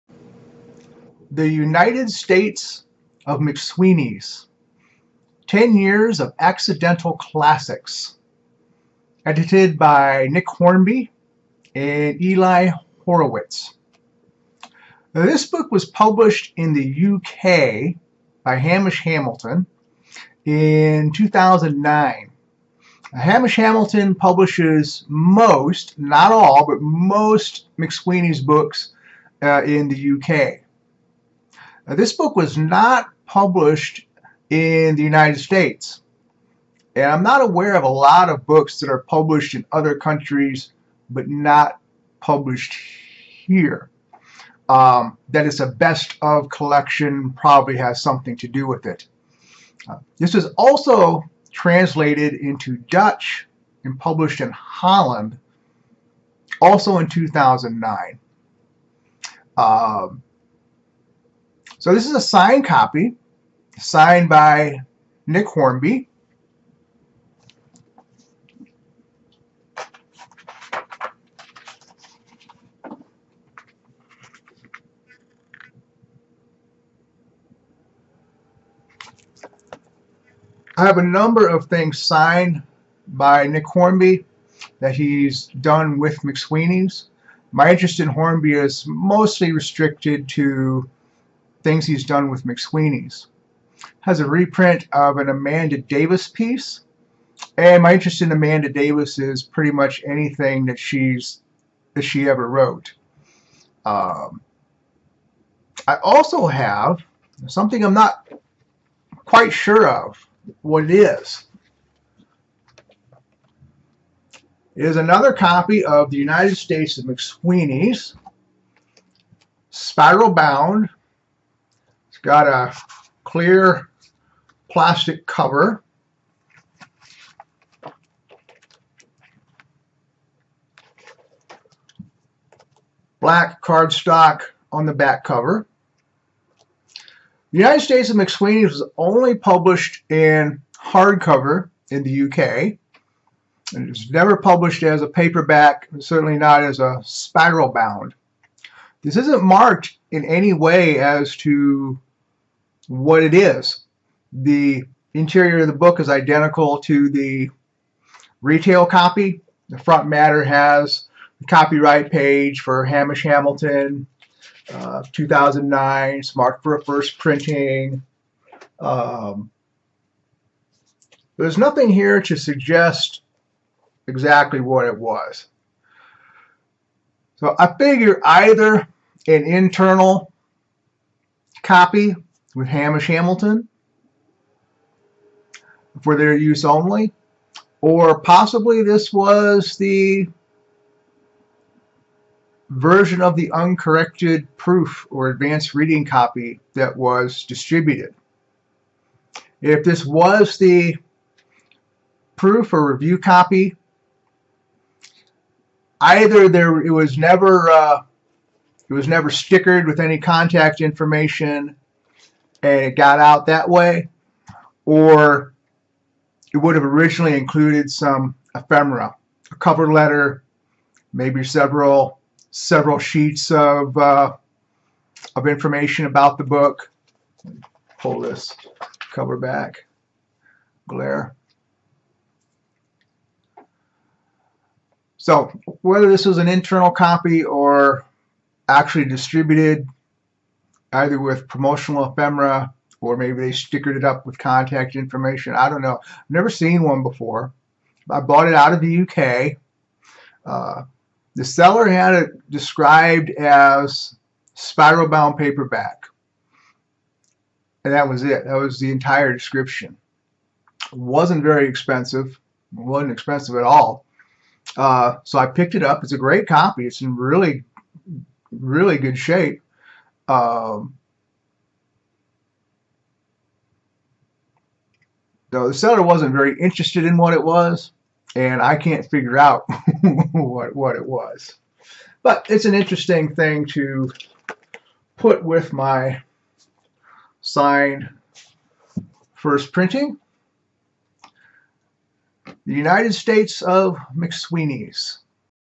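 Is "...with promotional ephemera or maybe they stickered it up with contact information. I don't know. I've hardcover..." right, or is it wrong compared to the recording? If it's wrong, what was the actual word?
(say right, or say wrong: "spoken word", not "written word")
wrong: "never", not "hardcover".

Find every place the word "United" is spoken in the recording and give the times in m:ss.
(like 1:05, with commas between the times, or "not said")
0:01, 0:35, 1:56, 2:17, 4:52.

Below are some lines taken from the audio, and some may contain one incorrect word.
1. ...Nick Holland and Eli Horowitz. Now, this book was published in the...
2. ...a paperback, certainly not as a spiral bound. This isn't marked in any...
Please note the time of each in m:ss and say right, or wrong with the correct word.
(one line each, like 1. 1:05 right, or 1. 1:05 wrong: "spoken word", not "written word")
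1. 0:10 wrong: "Hornby", not "Holland"
2. 2:25 right.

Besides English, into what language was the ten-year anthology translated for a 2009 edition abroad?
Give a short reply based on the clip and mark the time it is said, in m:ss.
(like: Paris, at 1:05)
Dutch, at 0:52.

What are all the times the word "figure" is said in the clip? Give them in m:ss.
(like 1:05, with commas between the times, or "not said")
2:57, 4:39.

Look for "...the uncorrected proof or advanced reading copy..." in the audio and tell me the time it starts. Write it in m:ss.
3:13.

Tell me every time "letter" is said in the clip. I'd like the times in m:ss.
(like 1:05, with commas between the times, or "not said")
3:39.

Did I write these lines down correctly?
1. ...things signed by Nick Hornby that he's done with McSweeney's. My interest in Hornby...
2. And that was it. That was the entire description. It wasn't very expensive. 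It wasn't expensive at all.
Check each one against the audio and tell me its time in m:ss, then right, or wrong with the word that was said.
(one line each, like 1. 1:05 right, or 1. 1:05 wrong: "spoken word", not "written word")
1. 1:21 right
2. 4:17 right.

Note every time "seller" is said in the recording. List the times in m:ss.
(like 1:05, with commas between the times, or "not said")
4:11, 4:35.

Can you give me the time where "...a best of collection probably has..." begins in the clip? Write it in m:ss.
0:45.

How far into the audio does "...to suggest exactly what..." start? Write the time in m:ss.
2:52.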